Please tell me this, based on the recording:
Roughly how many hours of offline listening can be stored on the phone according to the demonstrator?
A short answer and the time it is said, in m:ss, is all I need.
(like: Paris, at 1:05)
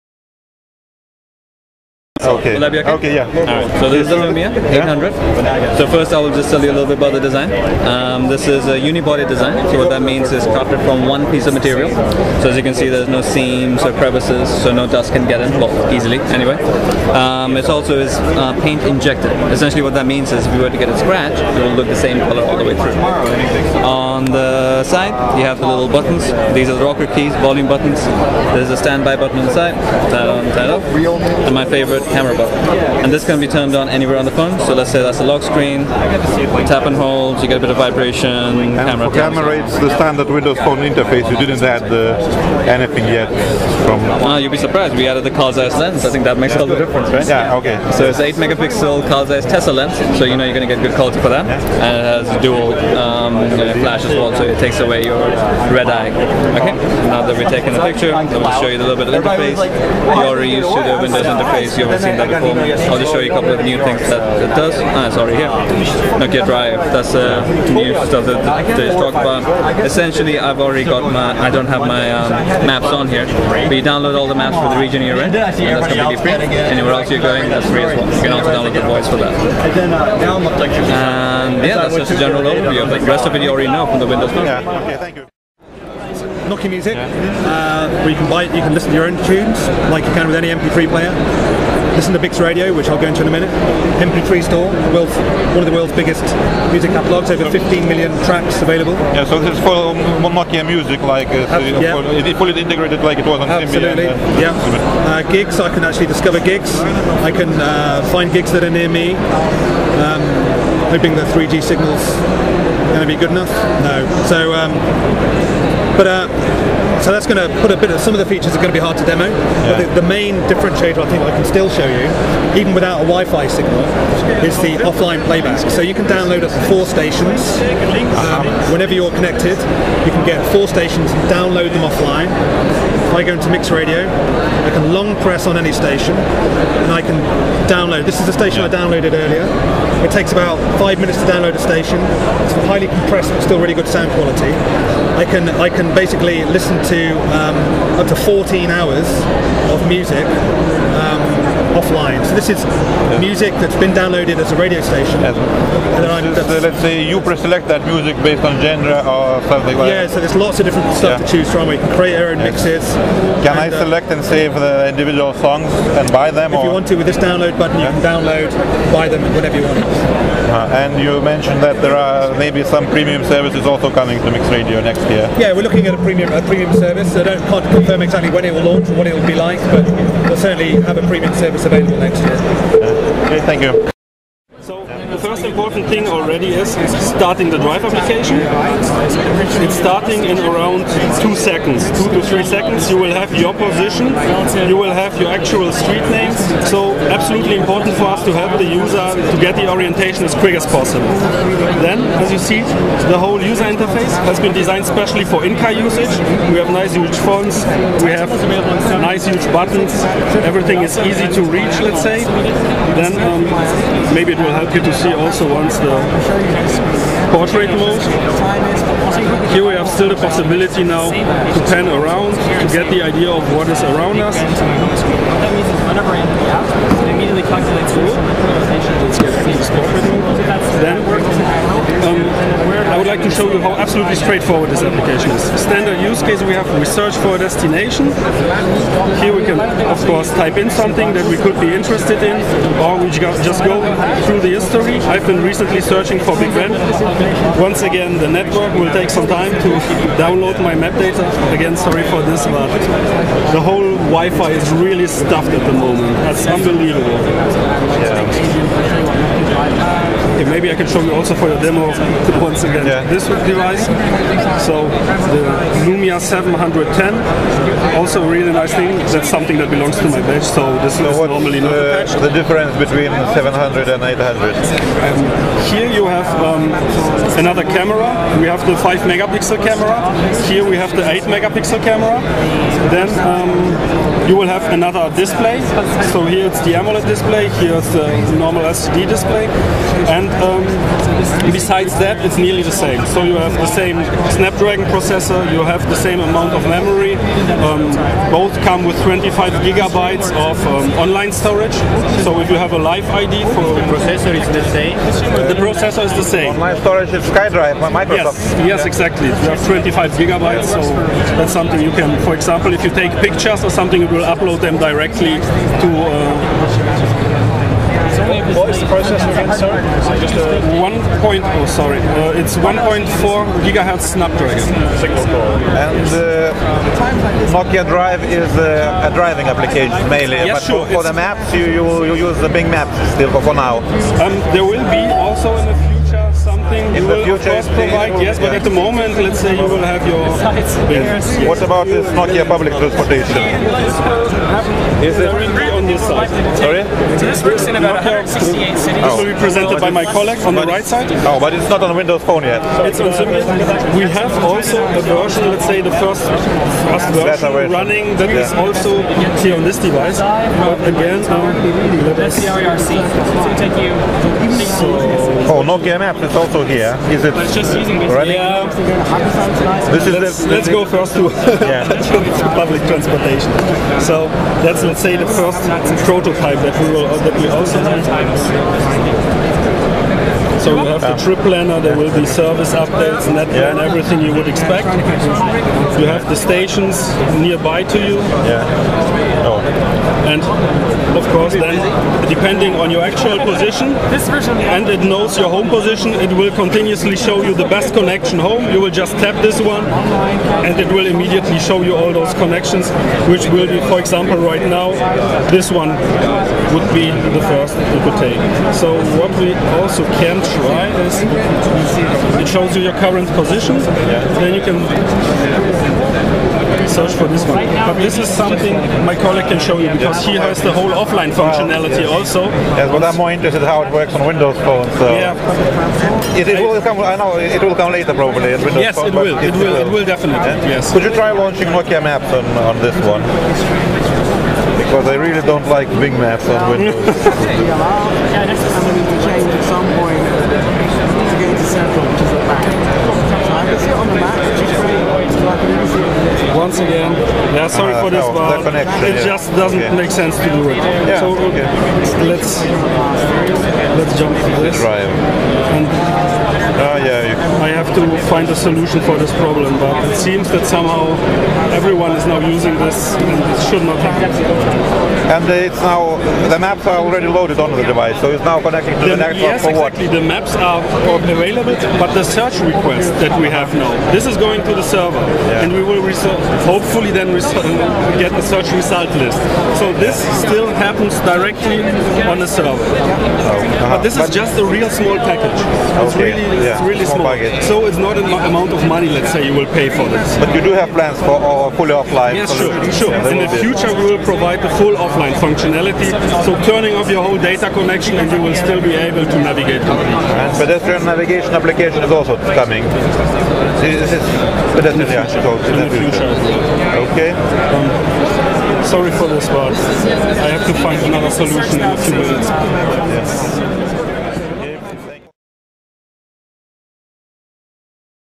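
14, at 2:28.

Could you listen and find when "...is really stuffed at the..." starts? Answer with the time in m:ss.
4:14.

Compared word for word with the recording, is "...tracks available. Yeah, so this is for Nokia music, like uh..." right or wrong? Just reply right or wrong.
right.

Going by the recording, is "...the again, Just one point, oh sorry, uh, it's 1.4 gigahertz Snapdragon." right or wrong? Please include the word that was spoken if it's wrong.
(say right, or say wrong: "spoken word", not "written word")
right.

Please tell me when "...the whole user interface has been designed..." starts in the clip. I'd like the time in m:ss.
3:23.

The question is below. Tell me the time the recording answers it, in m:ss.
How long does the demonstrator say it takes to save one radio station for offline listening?
2:20.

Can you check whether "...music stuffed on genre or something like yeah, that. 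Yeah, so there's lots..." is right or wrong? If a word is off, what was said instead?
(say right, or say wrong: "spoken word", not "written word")
wrong: "based", not "stuffed".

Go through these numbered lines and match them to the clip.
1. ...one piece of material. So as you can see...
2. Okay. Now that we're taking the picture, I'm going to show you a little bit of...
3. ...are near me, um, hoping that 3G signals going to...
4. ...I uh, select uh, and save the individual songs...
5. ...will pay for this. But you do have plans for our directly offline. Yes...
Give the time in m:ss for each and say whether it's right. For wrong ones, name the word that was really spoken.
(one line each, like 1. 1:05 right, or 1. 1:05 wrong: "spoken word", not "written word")
1. 0:11 right
2. 0:56 right
3. 1:48 right
4. 2:43 right
5. 8:09 wrong: "fully", not "directly".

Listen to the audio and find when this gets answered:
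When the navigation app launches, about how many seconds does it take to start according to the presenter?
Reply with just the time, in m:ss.
3:11.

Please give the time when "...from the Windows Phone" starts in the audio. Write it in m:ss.
1:23.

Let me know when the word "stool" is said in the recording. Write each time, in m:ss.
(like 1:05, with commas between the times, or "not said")
not said.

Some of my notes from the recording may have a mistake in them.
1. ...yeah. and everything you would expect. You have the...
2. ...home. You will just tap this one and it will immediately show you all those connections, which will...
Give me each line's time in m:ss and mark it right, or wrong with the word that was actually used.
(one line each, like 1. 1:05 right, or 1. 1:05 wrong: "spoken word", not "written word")
1. 6:23 right
2. 6:38 right.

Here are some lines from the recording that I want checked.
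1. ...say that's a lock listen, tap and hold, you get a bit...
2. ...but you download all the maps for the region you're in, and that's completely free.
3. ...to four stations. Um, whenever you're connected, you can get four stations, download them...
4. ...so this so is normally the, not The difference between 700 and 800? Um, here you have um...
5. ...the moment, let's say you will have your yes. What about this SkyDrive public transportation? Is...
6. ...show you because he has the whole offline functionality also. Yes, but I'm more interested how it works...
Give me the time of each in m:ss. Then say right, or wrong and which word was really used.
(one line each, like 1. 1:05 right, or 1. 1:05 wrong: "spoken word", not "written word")
1. 0:34 wrong: "screen", not "listen"
2. 1:13 right
3. 2:06 right
4. 4:30 right
5. 5:38 wrong: "Nokia", not "SkyDrive"
6. 6:59 right.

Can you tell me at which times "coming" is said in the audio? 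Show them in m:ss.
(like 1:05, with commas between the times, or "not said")
2:53, 8:22.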